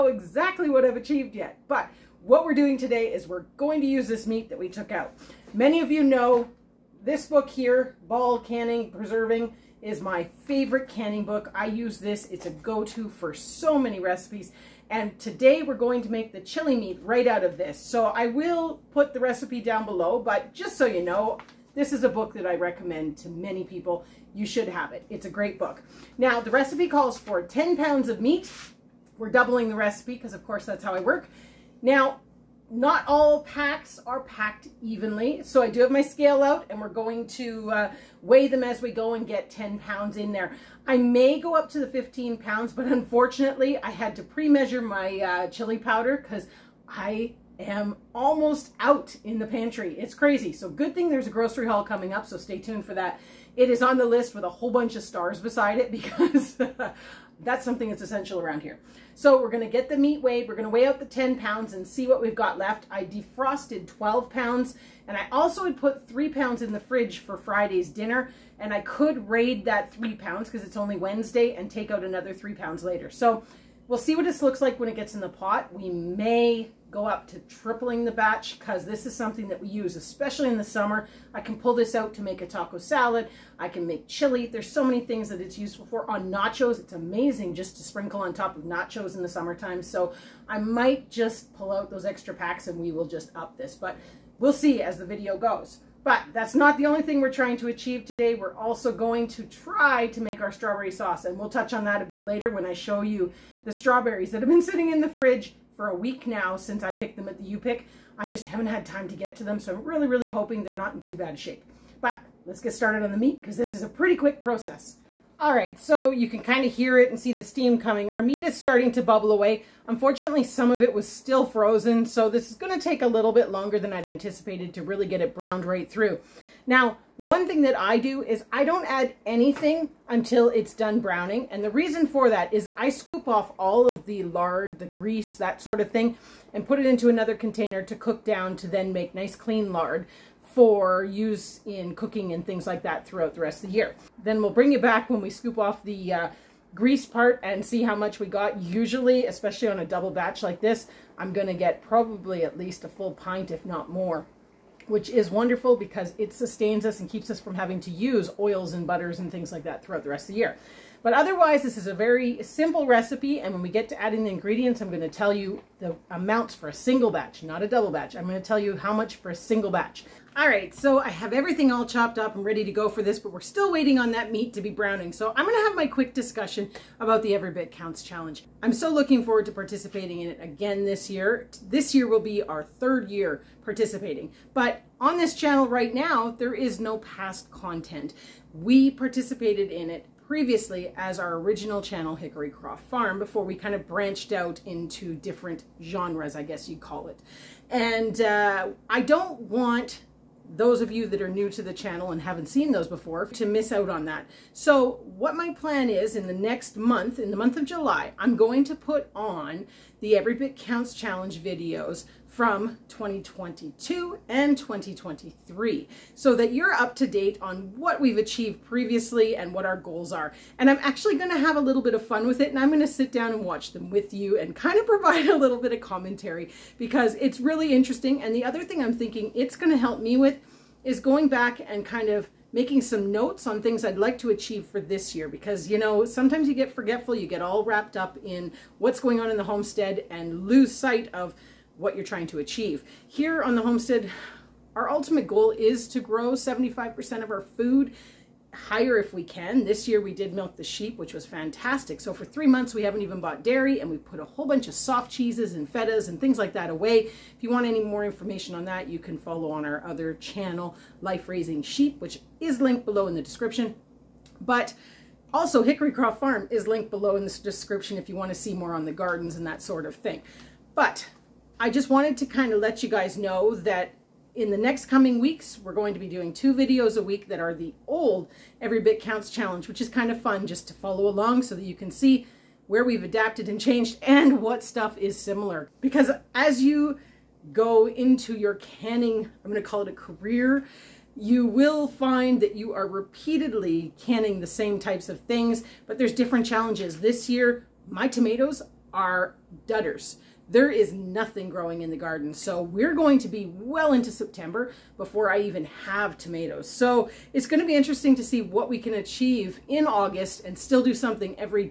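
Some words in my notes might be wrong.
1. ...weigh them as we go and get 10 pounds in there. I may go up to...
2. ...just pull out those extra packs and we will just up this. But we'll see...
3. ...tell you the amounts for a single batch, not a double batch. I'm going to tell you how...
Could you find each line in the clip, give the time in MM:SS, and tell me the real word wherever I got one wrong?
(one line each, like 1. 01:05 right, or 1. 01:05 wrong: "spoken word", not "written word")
1. 00:38 right
2. 01:31 right
3. 02:45 right.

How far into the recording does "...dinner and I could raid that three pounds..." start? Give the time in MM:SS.
01:07.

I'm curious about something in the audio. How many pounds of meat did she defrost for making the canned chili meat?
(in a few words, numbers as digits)
12 pounds.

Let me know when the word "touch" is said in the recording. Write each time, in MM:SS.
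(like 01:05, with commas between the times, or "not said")
01:41.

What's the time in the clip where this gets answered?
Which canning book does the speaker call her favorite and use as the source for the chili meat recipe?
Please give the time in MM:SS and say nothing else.
00:08.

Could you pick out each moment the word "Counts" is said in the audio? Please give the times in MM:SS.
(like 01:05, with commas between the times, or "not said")
02:57, 03:30, 04:39.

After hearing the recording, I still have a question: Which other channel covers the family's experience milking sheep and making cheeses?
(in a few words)
Life Raising Sheep.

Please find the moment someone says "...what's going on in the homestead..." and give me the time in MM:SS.
03:58.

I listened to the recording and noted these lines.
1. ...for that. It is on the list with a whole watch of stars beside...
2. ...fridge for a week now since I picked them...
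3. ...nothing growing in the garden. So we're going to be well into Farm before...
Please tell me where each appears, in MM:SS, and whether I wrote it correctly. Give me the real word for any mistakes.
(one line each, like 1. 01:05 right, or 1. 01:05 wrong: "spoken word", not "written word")
1. 00:52 wrong: "bunch", not "watch"
2. 01:45 right
3. 05:00 wrong: "September", not "Farm".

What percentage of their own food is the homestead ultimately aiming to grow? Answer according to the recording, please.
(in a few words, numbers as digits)
75%.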